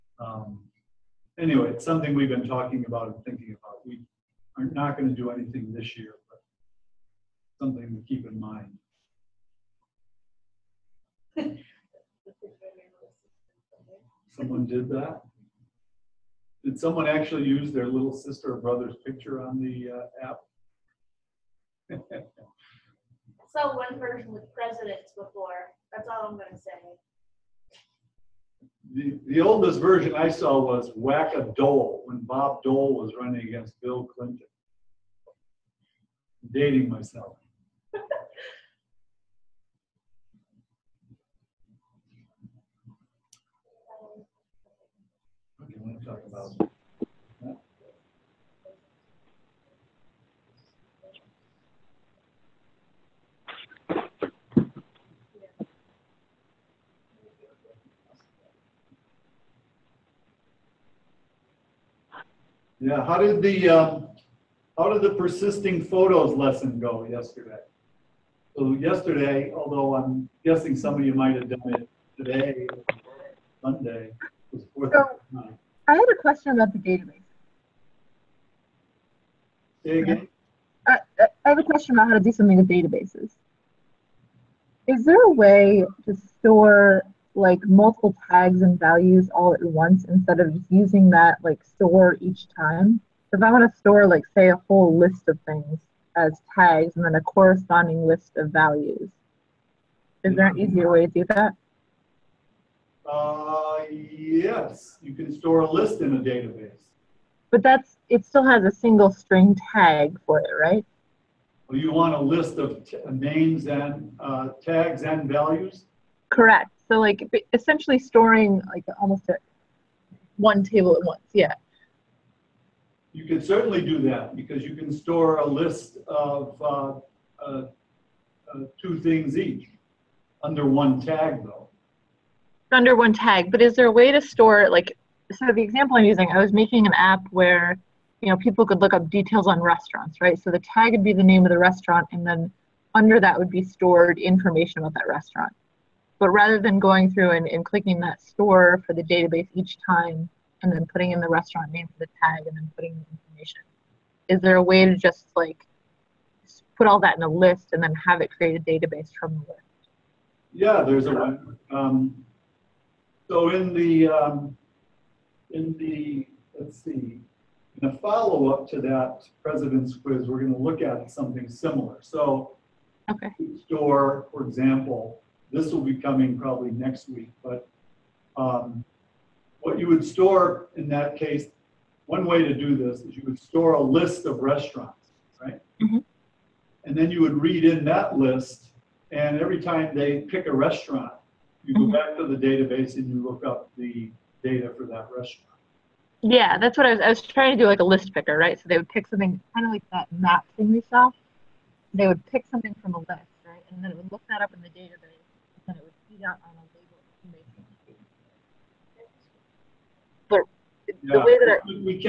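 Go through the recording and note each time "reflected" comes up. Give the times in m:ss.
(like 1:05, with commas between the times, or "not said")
not said.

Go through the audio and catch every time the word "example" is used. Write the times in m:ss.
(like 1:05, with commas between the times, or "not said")
2:15, 2:54.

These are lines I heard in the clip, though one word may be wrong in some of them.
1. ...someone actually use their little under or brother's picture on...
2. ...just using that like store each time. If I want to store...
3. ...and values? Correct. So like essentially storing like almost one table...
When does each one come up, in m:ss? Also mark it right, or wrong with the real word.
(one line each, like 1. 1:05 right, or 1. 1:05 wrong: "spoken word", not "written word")
1. 0:16 wrong: "sister", not "under"
2. 1:30 right
3. 1:55 right.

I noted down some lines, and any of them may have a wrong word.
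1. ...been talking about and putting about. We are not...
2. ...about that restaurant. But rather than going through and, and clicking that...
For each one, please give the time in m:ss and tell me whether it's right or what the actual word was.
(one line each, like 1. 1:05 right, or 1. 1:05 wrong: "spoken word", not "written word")
1. 0:02 wrong: "thinking", not "putting"
2. 2:24 right.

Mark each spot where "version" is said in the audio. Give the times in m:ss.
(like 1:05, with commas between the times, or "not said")
0:23, 0:29.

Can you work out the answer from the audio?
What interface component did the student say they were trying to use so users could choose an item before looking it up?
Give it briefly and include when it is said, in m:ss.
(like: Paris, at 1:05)
List picker, at 3:17.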